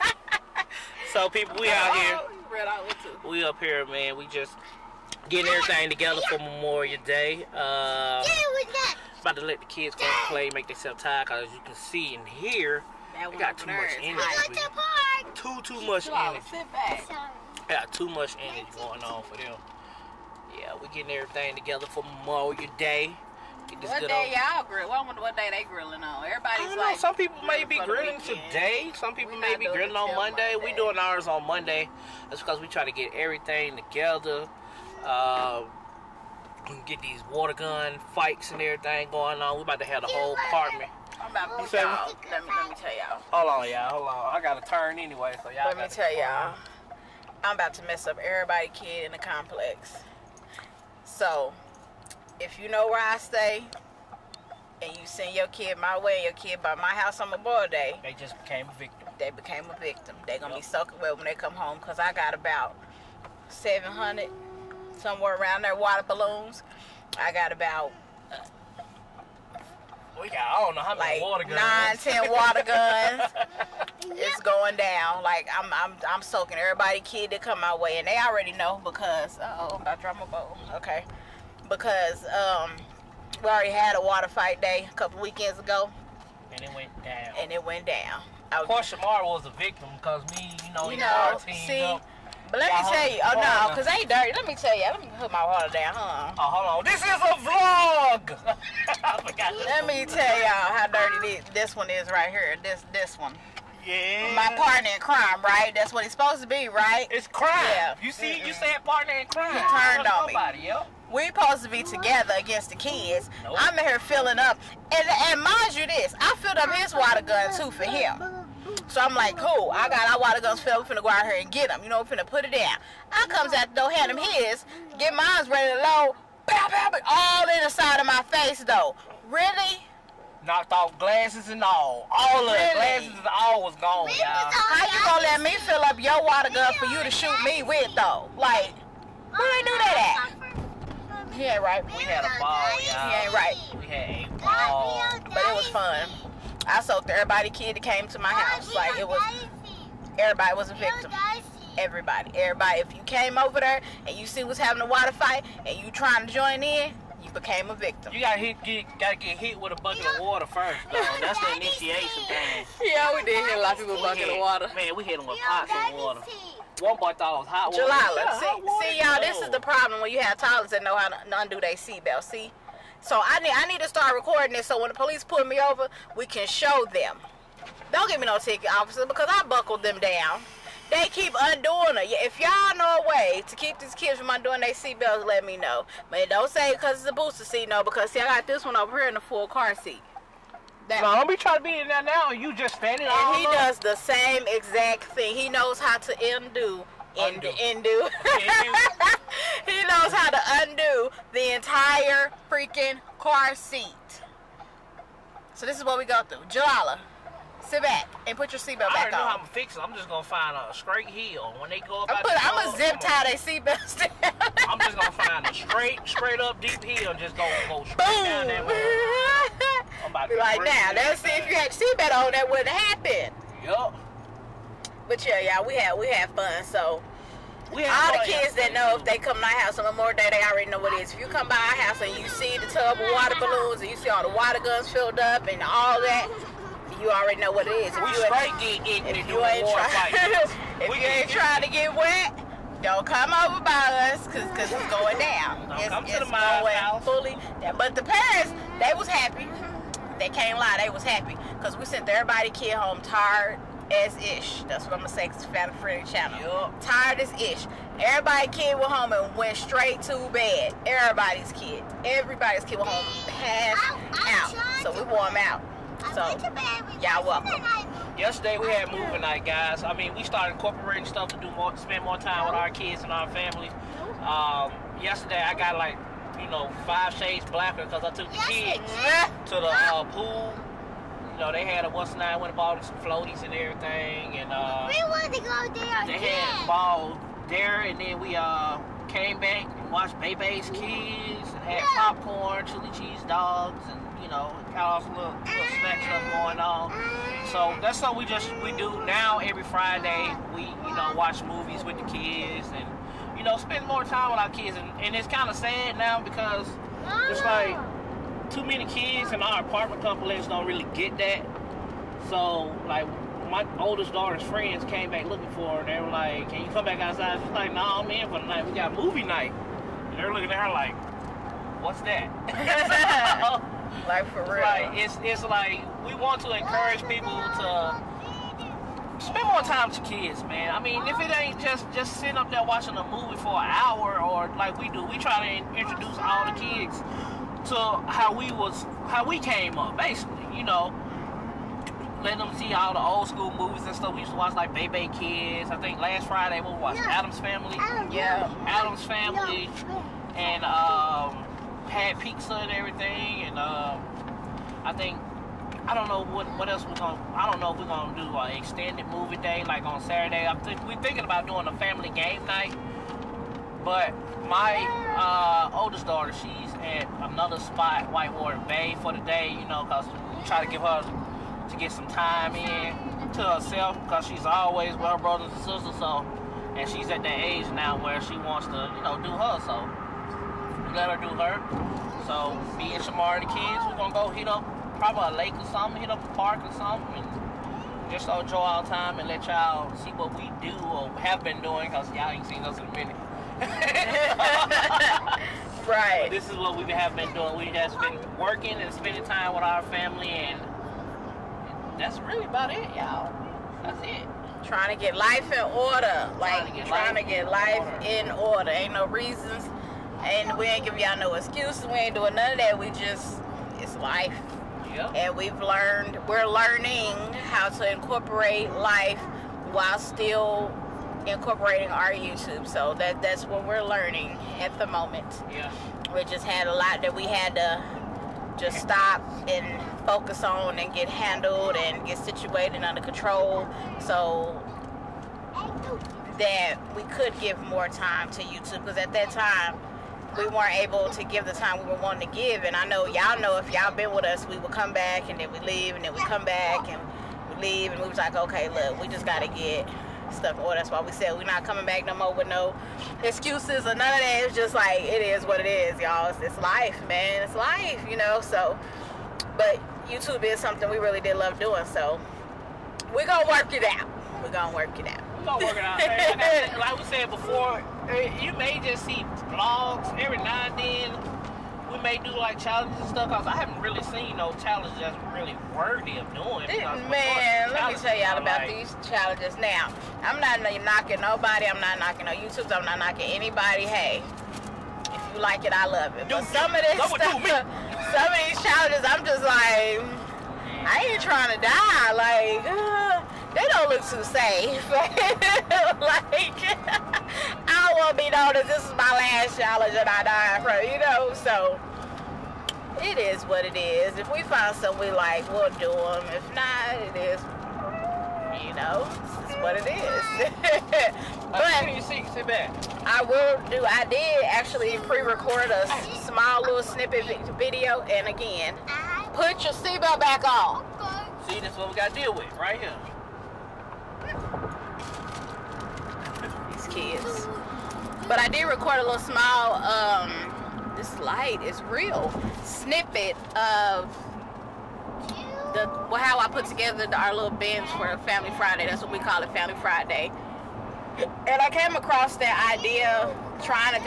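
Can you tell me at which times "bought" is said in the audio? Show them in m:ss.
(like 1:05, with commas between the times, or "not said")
4:42.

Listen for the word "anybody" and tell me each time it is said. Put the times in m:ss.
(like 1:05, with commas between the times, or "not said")
8:03.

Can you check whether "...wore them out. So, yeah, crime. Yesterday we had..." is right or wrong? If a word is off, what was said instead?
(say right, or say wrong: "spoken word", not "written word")
wrong: "welcome", not "crime".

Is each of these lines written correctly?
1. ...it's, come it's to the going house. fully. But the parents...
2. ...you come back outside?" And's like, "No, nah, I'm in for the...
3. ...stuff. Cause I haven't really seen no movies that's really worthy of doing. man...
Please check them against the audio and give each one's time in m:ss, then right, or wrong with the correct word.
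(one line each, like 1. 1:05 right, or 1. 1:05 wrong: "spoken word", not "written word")
1. 4:05 right
2. 5:16 wrong: "She", not "And"
3. 7:53 wrong: "challenges", not "movies".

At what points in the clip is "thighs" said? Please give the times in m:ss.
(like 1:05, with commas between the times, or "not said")
not said.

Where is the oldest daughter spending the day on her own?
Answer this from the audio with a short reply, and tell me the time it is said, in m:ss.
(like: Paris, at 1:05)
Whitewater Bay, at 6:08.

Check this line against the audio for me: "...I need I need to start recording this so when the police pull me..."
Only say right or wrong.
right.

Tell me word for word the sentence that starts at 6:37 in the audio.
We just been working and spending time with our family, and that's really about it, y'all.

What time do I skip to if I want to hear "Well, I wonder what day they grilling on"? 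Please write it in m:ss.
0:24.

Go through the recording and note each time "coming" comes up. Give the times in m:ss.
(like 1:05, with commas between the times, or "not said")
7:31.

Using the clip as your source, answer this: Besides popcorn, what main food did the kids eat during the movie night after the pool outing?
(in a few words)
Chili cheese dogs.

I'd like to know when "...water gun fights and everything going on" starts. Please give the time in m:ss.
0:37.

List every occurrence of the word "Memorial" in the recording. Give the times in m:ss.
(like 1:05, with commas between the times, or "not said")
0:06, 0:22, 0:57, 3:49.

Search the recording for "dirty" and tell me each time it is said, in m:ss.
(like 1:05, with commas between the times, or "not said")
1:34, 1:40.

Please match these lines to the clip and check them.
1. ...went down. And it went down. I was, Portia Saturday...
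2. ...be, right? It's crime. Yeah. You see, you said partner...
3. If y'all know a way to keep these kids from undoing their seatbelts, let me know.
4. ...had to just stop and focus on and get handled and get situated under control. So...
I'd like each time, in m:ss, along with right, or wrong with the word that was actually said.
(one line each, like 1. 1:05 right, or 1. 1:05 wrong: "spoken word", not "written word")
1. 1:26 wrong: "Mar", not "Saturday"
2. 1:46 right
3. 3:02 right
4. 7:07 right.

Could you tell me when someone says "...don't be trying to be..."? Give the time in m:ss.
3:11.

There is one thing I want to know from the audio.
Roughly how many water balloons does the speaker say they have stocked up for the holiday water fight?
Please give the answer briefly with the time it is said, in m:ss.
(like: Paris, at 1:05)
700, at 1:03.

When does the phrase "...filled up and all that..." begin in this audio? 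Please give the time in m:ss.
3:54.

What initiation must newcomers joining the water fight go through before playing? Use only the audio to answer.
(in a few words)
Hit with a bucket of water.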